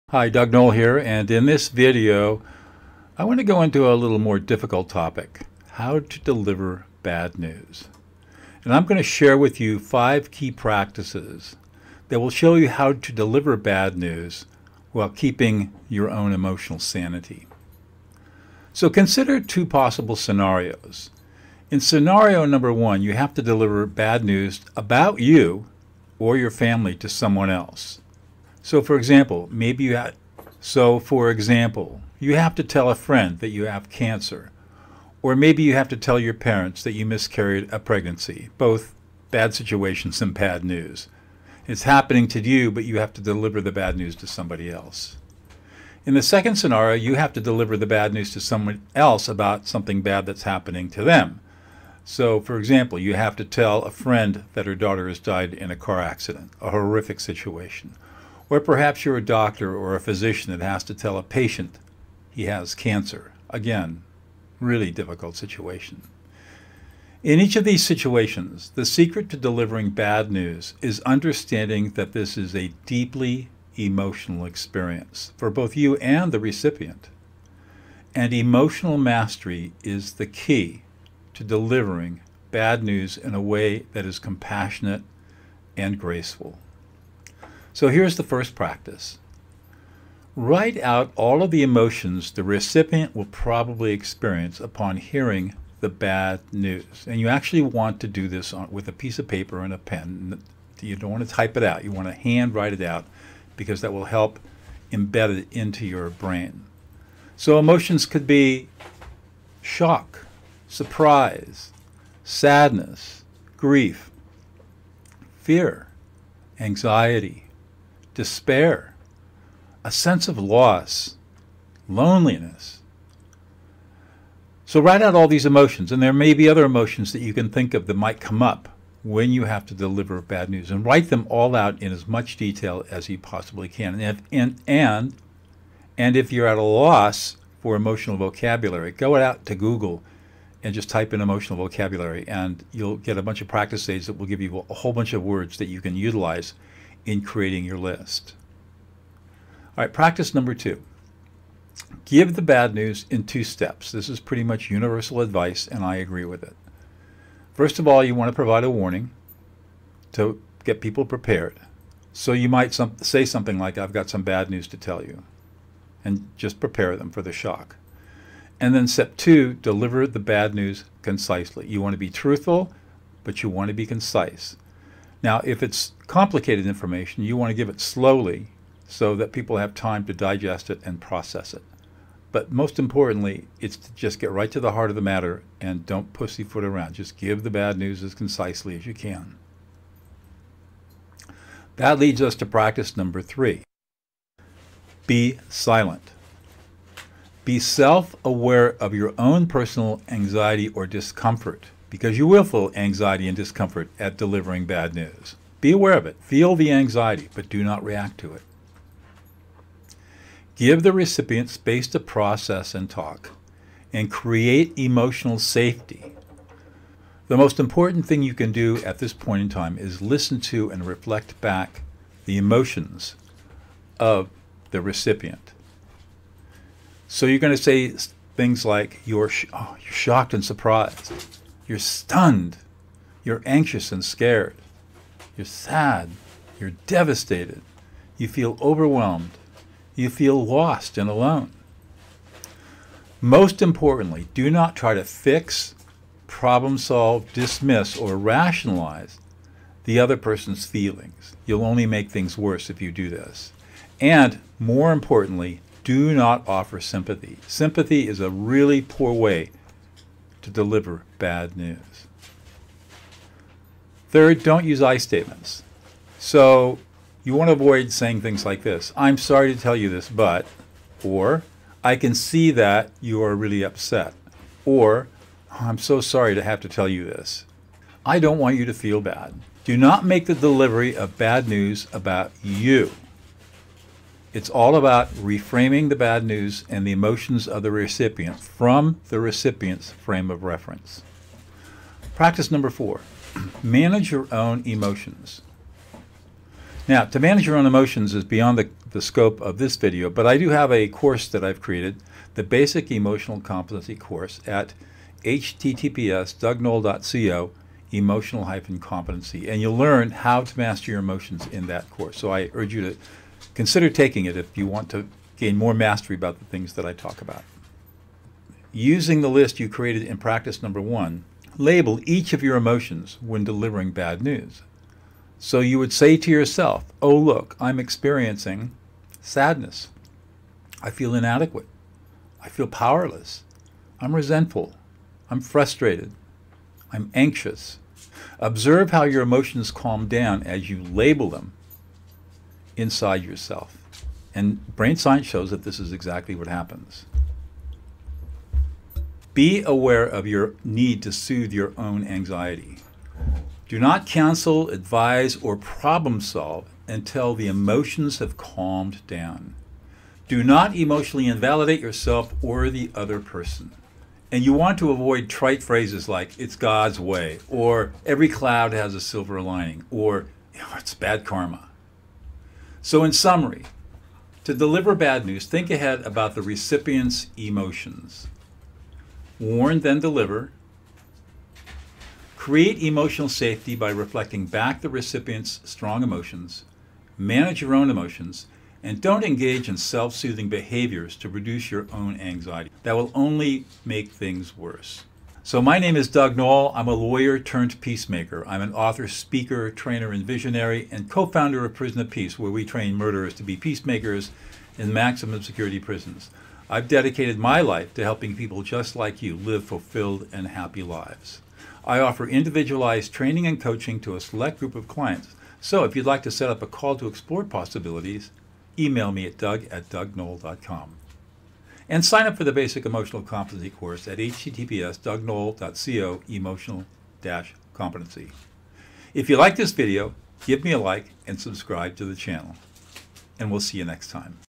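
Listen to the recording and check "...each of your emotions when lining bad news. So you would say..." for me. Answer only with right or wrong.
wrong.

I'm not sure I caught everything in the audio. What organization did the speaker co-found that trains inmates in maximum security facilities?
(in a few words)
Prison of Peace.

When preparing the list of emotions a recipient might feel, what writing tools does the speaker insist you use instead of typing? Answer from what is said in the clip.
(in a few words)
A piece of paper and a pen.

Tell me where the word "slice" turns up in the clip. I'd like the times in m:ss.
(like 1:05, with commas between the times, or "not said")
not said.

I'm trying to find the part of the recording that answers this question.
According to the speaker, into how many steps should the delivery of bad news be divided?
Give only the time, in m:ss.
2:33.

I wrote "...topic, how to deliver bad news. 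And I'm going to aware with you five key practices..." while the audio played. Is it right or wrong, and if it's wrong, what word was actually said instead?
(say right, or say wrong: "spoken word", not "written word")
wrong: "share", not "aware".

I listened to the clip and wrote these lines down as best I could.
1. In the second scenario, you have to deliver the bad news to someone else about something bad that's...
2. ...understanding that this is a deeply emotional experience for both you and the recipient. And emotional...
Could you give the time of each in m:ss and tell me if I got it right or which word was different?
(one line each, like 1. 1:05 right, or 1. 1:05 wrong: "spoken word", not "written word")
1. 0:46 right
2. 1:11 right.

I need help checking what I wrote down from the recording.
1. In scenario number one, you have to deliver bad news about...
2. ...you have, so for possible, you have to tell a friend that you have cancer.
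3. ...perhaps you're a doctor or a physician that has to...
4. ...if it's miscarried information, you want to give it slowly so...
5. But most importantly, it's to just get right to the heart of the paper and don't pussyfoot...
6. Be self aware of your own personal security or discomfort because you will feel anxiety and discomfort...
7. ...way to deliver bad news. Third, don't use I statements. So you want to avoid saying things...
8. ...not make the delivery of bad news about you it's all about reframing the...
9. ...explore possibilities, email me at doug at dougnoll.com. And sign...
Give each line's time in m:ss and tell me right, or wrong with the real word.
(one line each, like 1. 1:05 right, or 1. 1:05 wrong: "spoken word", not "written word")
1. 0:21 right
2. 0:29 wrong: "example", not "possible"
3. 0:58 right
4. 2:55 wrong: "complicated", not "miscarried"
5. 3:02 wrong: "matter", not "paper"
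6. 3:17 wrong: "anxiety", not "security"
7. 4:19 right
8. 4:39 right
9. 6:57 right.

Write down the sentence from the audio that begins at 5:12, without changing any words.
So I urge you to Consider taking it if you want to gain more mastery about the things that I talk about.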